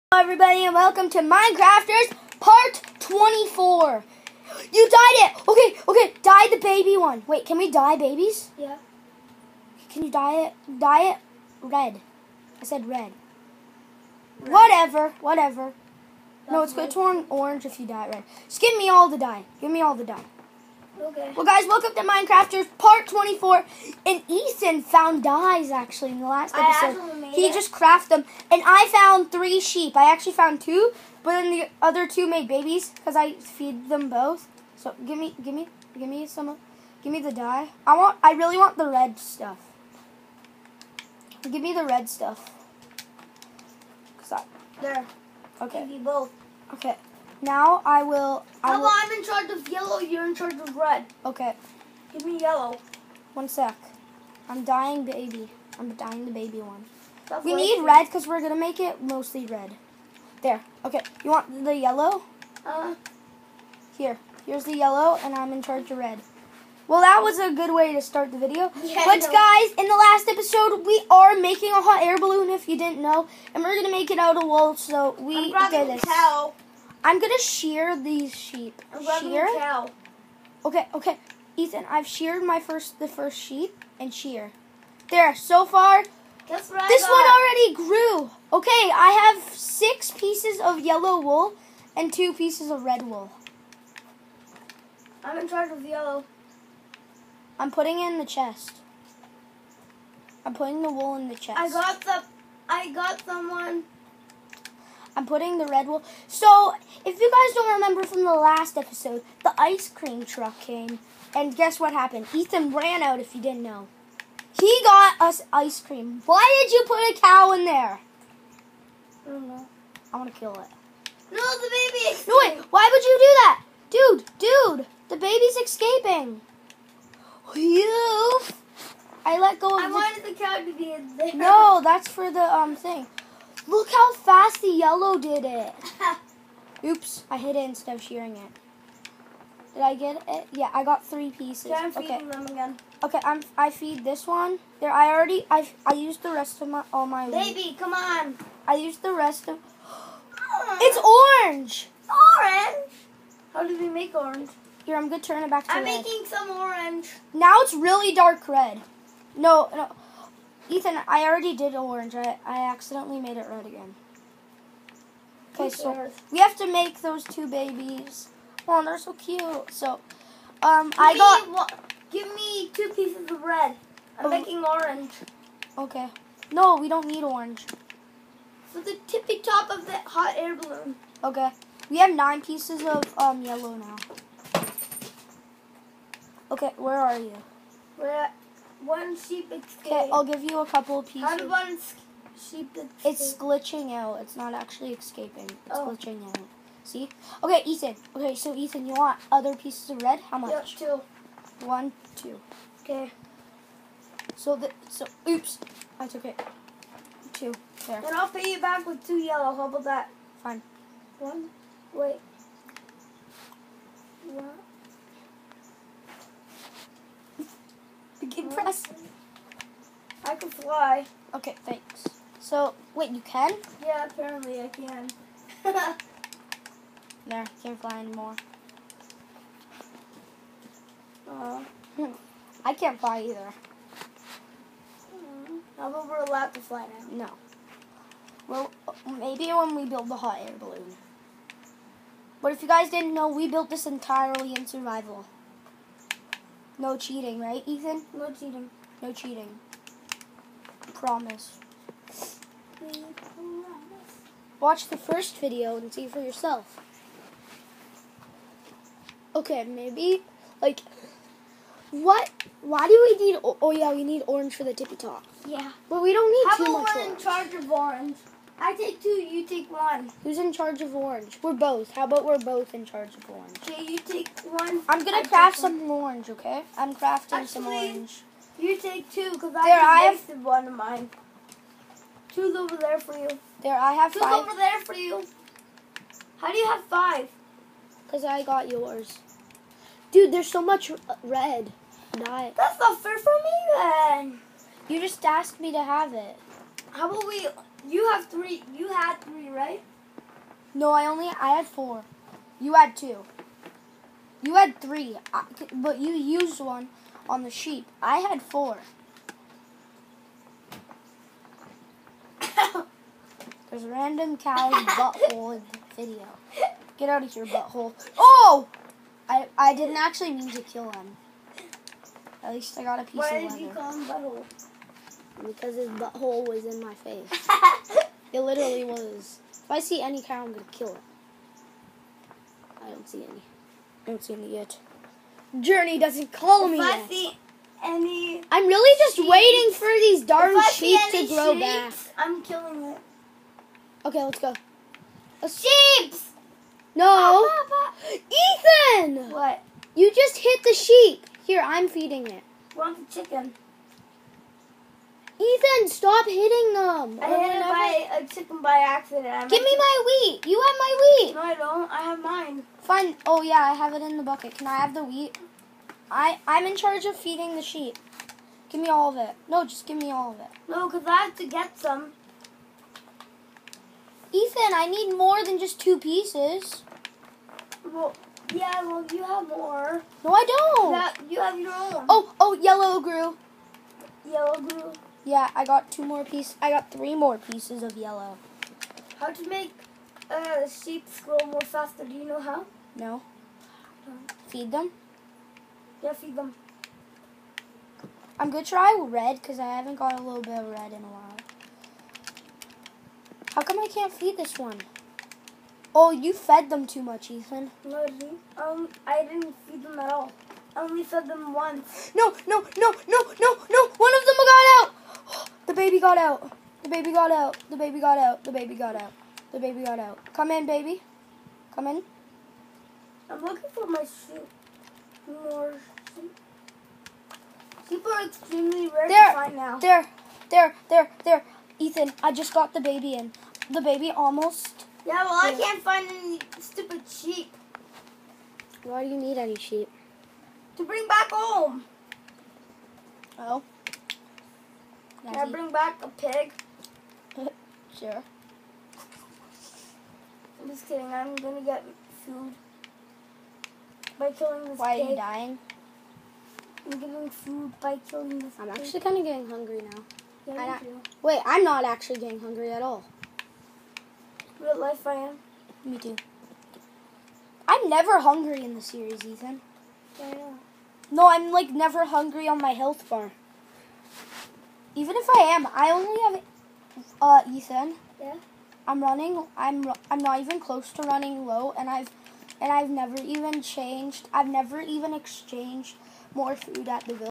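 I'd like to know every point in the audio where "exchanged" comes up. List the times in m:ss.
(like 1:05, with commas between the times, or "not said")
8:05.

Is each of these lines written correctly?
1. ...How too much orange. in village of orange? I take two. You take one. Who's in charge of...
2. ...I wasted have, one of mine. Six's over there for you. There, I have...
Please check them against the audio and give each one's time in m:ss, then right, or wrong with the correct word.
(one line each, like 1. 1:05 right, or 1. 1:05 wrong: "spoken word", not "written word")
1. 4:26 wrong: "charge", not "village"
2. 4:39 wrong: "Two", not "Six".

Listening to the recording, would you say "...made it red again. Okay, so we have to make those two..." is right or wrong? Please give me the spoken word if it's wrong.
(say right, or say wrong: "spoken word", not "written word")
right.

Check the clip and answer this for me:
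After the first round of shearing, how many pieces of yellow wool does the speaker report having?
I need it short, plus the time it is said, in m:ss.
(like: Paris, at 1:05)
6, at 1:29.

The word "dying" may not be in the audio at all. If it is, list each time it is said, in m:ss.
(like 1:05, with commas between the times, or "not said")
0:54, 7:35.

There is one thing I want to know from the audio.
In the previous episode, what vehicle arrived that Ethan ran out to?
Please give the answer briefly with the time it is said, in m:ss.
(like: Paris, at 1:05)
The ice cream truck, at 1:49.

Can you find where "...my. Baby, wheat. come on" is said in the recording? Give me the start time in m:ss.
2:27.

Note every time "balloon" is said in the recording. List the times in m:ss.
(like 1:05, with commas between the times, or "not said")
1:12, 3:00, 4:00.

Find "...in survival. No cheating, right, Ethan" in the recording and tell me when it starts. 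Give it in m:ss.
4:04.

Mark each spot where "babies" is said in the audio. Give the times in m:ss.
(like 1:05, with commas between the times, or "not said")
0:07, 0:32, 2:47.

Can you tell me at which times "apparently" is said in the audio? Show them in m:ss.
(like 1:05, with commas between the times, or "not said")
3:44.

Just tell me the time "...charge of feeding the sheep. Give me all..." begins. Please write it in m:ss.
6:06.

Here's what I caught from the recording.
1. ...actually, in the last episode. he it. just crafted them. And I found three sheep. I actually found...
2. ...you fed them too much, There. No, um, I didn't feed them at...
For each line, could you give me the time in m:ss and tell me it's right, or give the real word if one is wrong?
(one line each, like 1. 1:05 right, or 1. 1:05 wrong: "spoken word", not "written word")
1. 0:25 right
2. 6:46 wrong: "Ethan", not "There".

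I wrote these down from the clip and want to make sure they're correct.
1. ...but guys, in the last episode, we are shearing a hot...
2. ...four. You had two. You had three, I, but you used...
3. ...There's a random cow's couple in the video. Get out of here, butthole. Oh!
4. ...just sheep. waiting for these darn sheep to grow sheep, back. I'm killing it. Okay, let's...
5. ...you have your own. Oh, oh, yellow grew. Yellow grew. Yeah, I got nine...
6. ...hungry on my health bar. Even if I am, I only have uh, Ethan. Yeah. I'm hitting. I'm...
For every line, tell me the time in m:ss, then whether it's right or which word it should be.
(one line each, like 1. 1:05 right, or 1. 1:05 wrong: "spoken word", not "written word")
1. 1:09 wrong: "making", not "shearing"
2. 5:01 right
3. 5:13 wrong: "butthole", not "couple"
4. 5:38 right
5. 6:21 wrong: "two", not "nine"
6. 7:52 wrong: "running", not "hitting".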